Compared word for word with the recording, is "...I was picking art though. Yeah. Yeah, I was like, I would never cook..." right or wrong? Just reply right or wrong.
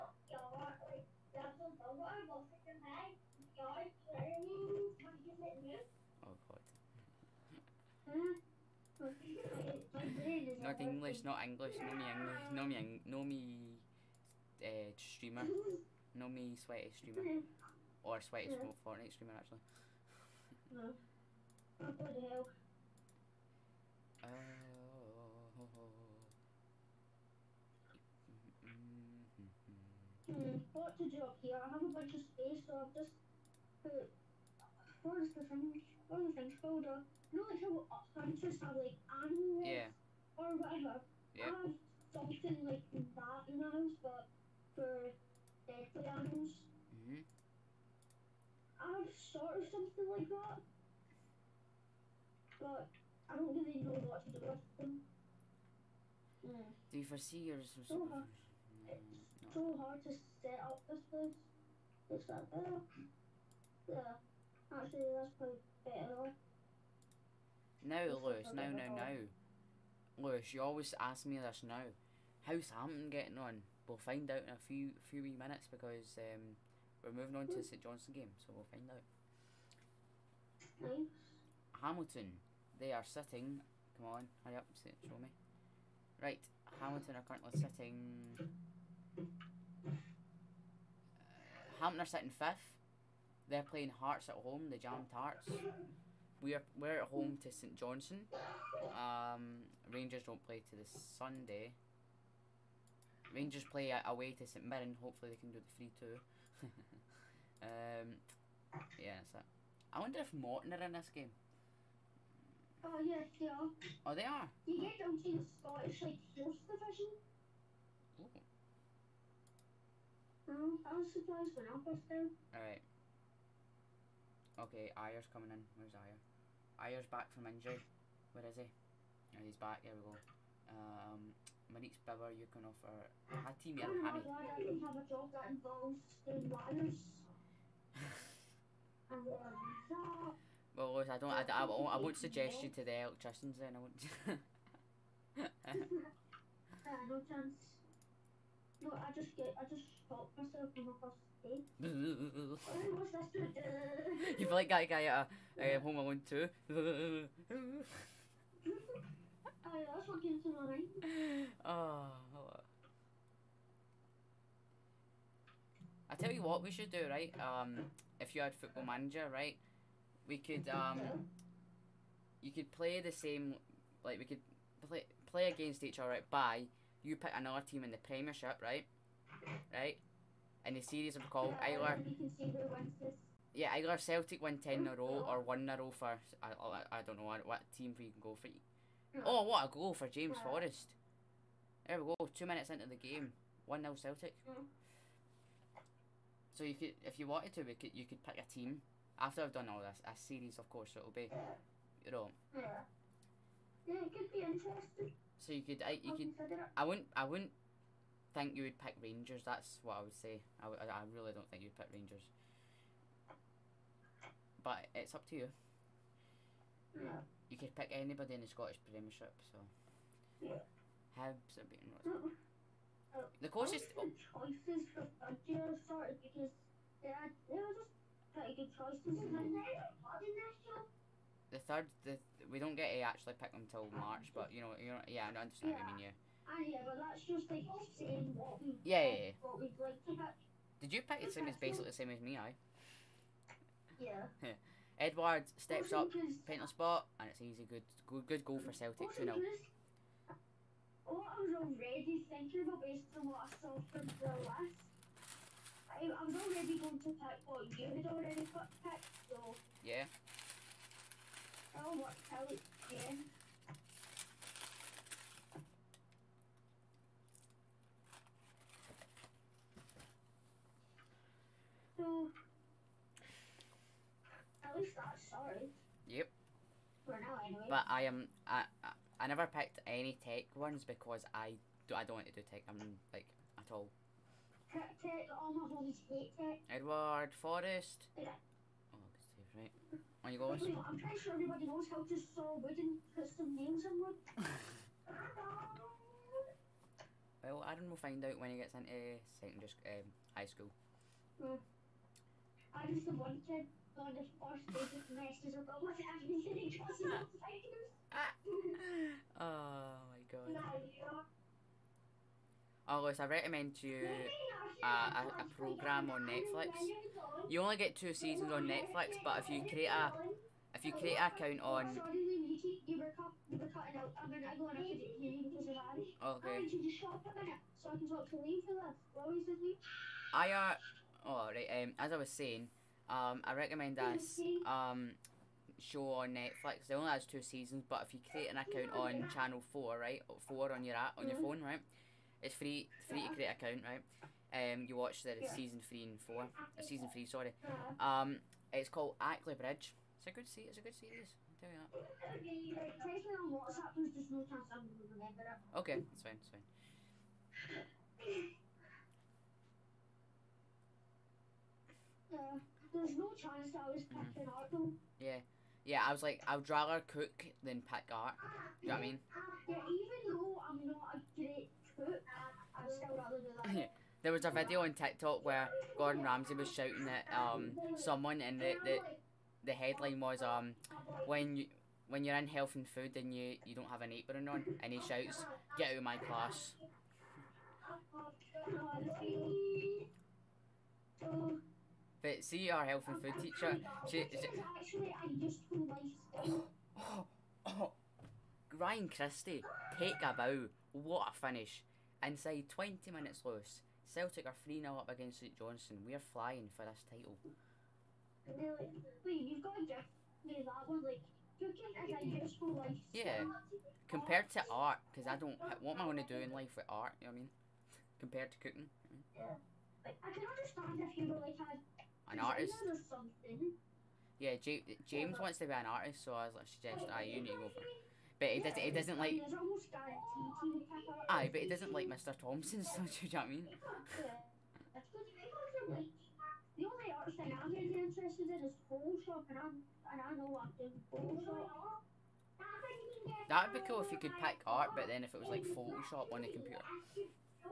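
wrong.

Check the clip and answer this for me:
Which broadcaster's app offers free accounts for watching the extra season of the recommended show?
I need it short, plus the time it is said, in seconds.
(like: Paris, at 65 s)
Channel Four, at 339 s.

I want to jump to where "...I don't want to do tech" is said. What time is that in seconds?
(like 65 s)
281 s.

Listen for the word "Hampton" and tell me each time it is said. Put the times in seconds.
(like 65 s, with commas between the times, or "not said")
72 s, 91 s.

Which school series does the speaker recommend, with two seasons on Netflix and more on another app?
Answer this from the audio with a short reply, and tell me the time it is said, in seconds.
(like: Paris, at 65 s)
Ackley Bridge, at 349 s.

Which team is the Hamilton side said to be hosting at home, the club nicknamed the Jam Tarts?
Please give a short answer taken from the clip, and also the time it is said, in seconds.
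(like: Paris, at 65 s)
Hearts, at 93 s.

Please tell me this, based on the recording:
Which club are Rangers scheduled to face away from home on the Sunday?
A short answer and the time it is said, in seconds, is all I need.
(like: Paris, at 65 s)
St Mirren, at 104 s.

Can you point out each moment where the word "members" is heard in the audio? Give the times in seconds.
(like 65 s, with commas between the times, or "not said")
not said.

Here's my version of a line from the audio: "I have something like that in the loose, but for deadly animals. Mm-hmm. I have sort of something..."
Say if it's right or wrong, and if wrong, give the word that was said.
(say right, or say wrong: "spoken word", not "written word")
wrong: "house", not "loose".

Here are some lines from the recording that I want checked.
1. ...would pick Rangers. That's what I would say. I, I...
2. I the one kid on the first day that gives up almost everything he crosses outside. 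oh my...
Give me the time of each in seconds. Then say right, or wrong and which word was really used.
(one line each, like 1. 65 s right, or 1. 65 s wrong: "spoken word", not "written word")
1. 208 s right
2. 302 s wrong: "messes", not "gives".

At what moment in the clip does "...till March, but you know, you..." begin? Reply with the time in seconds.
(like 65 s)
233 s.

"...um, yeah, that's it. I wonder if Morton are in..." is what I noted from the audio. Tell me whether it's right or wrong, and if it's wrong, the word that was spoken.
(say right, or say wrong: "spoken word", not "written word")
right.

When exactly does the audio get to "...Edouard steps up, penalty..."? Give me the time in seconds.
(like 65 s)
244 s.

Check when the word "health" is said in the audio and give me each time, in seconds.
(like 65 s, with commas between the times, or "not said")
382 s, 392 s.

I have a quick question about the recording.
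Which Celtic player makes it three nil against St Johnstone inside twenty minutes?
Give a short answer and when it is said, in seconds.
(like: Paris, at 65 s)
Ryan Christie, at 398 s.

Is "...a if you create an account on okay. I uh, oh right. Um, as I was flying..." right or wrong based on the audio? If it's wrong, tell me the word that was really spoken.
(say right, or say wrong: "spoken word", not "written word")
wrong: "saying", not "flying".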